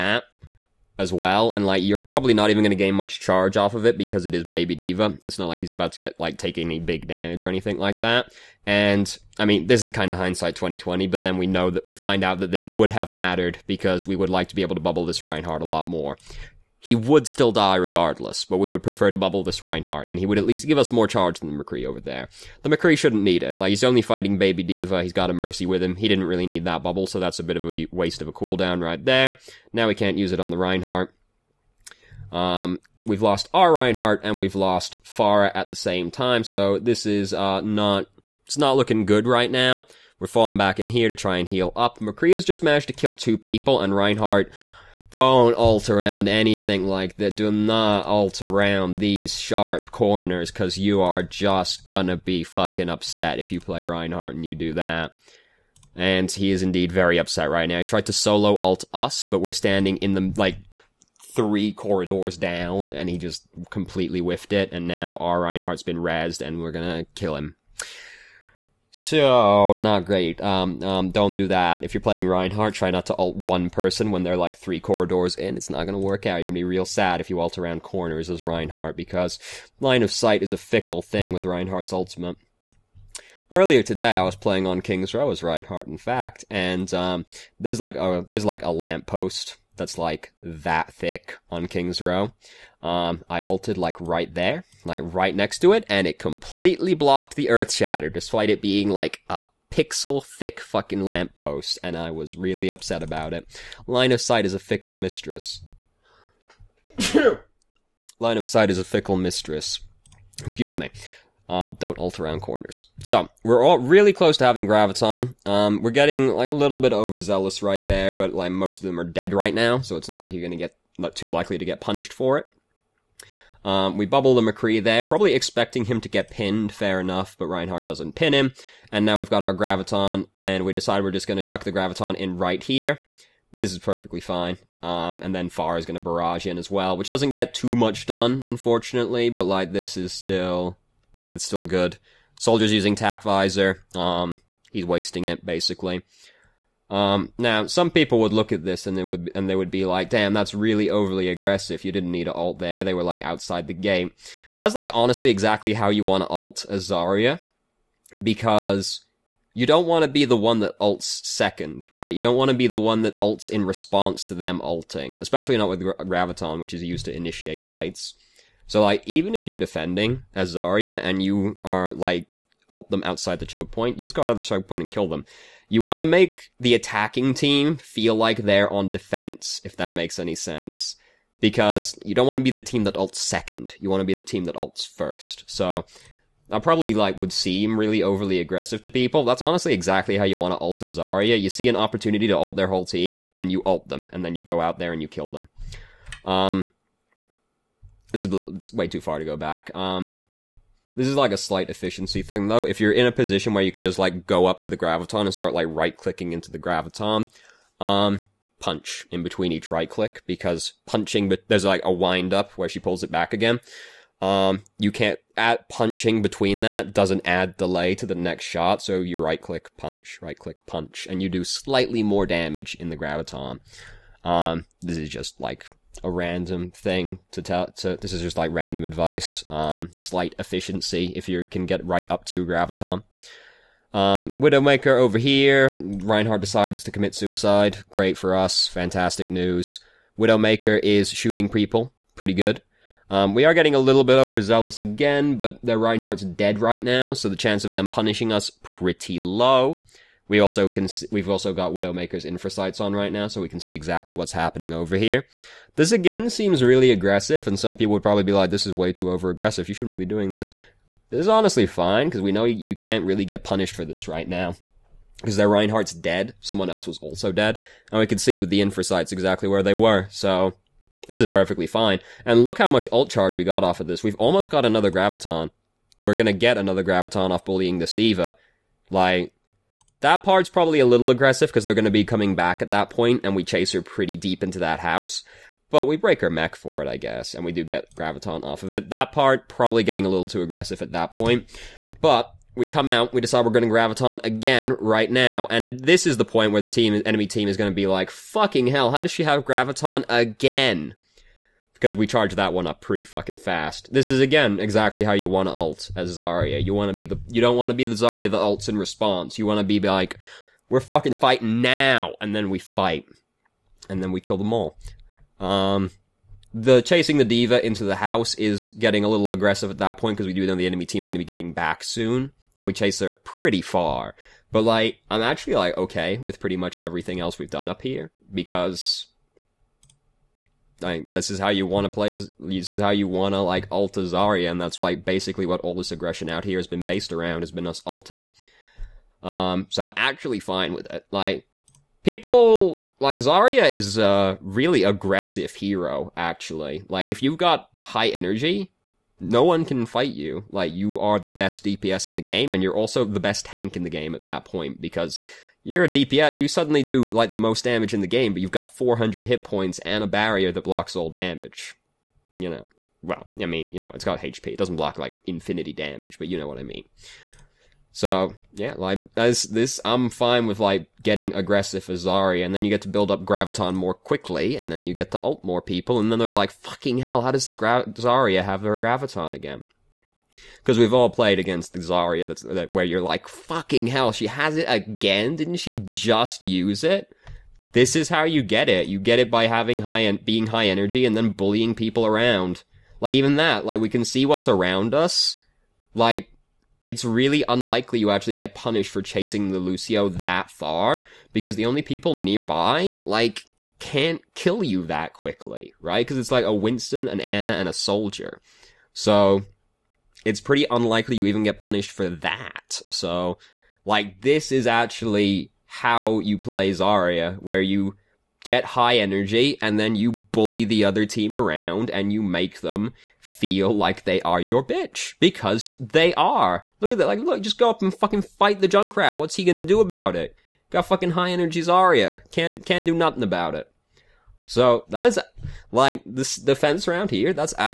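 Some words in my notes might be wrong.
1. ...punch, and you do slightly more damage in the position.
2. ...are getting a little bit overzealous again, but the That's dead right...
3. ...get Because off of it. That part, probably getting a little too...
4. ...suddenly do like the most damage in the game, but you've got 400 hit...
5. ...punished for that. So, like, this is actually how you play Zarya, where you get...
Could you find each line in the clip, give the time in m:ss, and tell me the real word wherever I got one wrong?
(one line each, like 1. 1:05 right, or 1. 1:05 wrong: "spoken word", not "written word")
1. 3:40 wrong: "graviton", not "position"
2. 4:03 wrong: "Reinhardt", not "That"
3. 4:47 wrong: "Graviton", not "Because"
4. 5:56 right
5. 6:51 right.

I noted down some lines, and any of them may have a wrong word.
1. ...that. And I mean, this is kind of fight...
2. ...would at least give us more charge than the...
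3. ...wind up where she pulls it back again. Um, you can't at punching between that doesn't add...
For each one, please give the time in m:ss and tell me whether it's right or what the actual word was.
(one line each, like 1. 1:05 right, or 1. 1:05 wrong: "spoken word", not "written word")
1. 0:07 wrong: "hindsight", not "fight"
2. 0:20 right
3. 3:31 right.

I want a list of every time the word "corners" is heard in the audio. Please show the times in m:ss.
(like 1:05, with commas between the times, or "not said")
0:49, 1:17, 1:52.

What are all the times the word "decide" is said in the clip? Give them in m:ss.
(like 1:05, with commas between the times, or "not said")
2:10, 3:56, 4:53.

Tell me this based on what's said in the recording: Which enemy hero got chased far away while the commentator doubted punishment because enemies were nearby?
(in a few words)
Lucio.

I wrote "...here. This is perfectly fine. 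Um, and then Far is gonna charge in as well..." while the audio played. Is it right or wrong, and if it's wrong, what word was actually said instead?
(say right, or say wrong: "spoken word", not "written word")
wrong: "barrage", not "charge".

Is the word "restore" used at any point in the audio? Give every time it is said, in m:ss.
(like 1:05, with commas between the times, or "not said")
not said.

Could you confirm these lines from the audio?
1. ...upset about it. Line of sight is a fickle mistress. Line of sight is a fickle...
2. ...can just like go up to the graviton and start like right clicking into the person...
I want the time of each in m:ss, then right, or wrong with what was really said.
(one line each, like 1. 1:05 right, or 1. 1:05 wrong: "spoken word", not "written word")
1. 1:42 right
2. 3:23 wrong: "graviton", not "person".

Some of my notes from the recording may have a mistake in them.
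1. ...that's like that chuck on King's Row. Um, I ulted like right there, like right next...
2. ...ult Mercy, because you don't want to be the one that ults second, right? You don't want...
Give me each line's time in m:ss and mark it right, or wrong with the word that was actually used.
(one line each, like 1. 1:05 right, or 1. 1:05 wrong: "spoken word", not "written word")
1. 1:29 wrong: "thick", not "chuck"
2. 2:36 wrong: "Azaria", not "Mercy".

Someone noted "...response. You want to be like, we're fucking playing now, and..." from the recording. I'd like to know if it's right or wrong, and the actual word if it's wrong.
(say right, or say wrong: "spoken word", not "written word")
wrong: "fighting", not "playing".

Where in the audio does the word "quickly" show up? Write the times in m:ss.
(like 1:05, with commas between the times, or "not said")
6:13, 6:45.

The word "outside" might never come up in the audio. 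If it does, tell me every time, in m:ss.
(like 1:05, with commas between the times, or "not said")
2:33, 2:53.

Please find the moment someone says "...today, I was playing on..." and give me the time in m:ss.
1:23.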